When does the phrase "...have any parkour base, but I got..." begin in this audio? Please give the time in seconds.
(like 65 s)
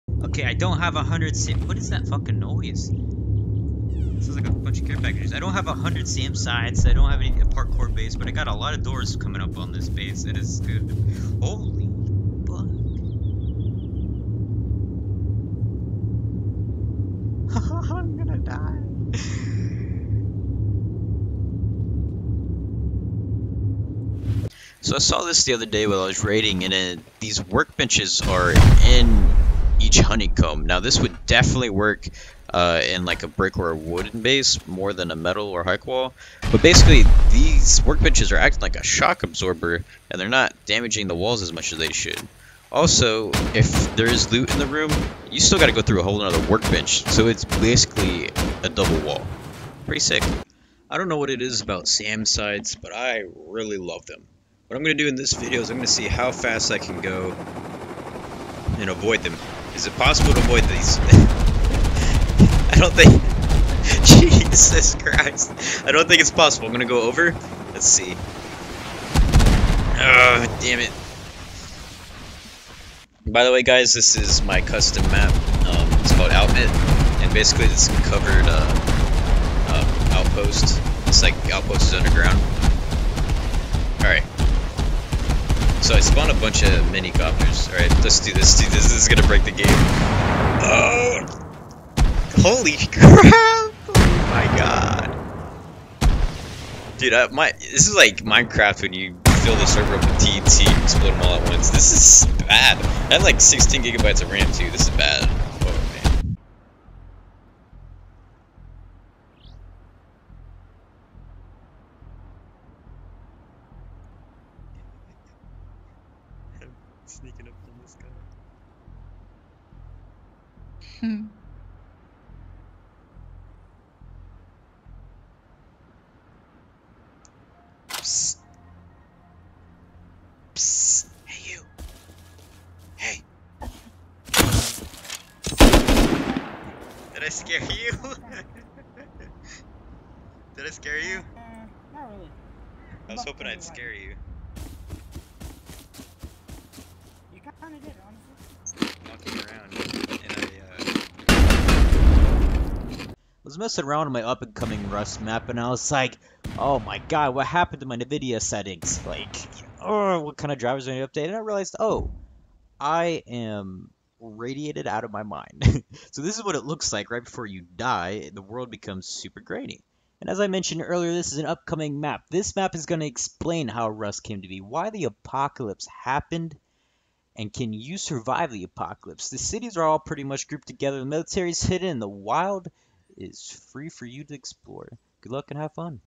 7 s.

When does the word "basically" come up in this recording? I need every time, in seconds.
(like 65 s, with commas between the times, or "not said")
36 s, 47 s, 77 s.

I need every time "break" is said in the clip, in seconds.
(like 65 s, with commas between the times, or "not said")
89 s.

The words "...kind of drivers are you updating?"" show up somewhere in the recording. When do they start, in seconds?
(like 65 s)
160 s.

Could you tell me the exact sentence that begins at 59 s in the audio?
Is it possible to avoid these?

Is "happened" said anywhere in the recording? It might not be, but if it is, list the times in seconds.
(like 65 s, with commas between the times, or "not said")
157 s, 175 s.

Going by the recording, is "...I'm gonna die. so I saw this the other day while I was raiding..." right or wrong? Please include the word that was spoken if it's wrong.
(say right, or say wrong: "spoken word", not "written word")
right.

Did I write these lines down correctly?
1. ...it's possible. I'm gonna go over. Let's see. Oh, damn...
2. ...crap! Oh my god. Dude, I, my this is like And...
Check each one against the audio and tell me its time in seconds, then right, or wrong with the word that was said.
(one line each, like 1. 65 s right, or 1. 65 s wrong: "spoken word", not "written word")
1. 66 s right
2. 92 s wrong: "Minecraft", not "And".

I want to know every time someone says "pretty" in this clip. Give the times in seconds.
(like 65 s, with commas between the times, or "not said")
49 s, 179 s.